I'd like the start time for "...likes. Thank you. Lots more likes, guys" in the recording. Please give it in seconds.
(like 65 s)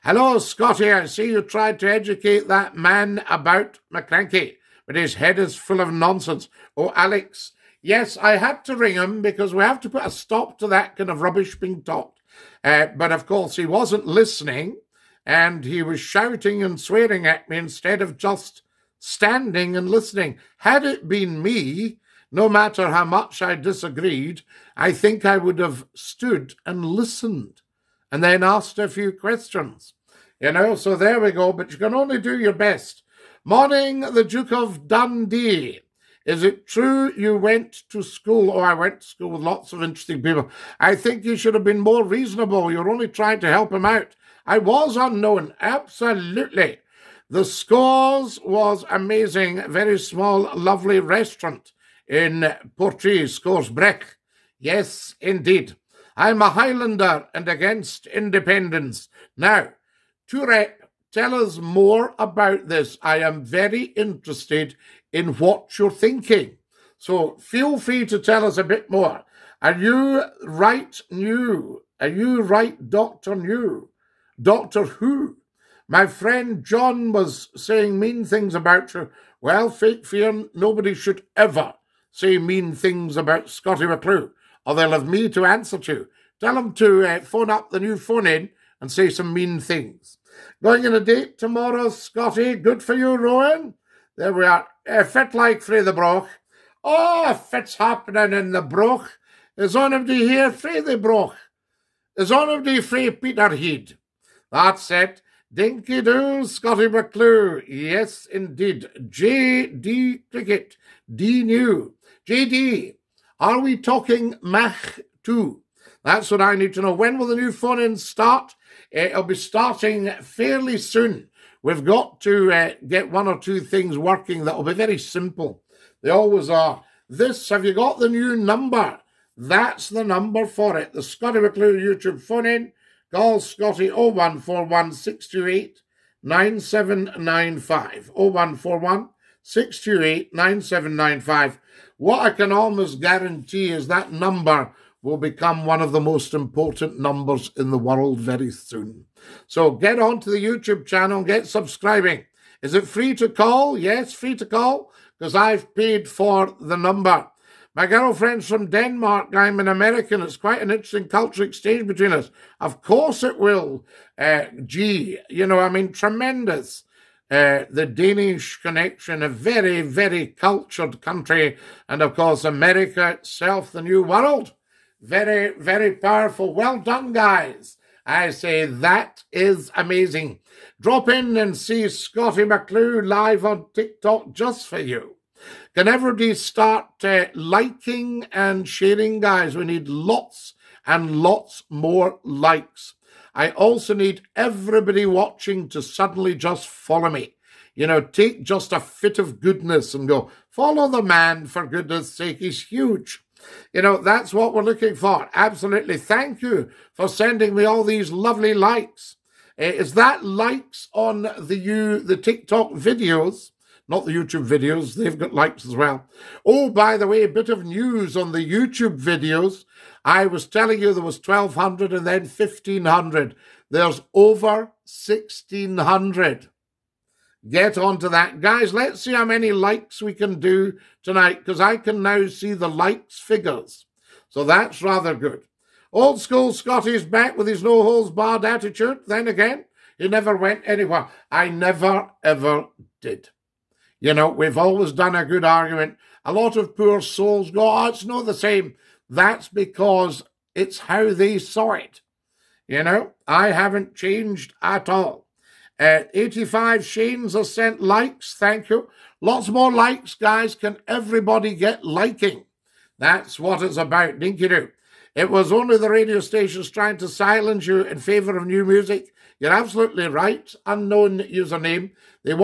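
257 s.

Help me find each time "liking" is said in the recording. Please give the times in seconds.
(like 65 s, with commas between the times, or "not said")
187 s, 261 s.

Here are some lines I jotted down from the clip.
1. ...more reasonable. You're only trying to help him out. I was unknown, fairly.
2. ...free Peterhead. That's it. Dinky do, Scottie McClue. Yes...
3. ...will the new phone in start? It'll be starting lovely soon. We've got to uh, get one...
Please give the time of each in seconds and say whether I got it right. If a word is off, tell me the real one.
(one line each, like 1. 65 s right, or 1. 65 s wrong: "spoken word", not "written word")
1. 41 s wrong: "absolutely", not "fairly"
2. 102 s right
3. 117 s wrong: "fairly", not "lovely".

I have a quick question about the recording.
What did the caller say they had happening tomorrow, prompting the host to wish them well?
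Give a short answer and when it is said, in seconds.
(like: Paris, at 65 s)
A date, at 90 s.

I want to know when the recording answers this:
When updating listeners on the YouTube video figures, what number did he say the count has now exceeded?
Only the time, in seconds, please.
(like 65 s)
225 s.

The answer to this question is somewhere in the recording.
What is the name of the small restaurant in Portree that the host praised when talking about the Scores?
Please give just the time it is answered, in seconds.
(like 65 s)
53 s.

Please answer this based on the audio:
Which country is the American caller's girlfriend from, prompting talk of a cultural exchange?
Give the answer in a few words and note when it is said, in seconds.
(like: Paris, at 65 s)
Denmark, at 158 s.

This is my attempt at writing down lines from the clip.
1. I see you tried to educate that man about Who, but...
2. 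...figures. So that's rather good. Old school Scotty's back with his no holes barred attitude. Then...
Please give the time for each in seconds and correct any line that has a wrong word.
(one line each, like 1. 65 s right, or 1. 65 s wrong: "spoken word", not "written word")
1. 0 s wrong: "McCranky", not "Who"
2. 233 s right.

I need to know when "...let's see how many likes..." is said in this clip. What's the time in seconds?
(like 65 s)
228 s.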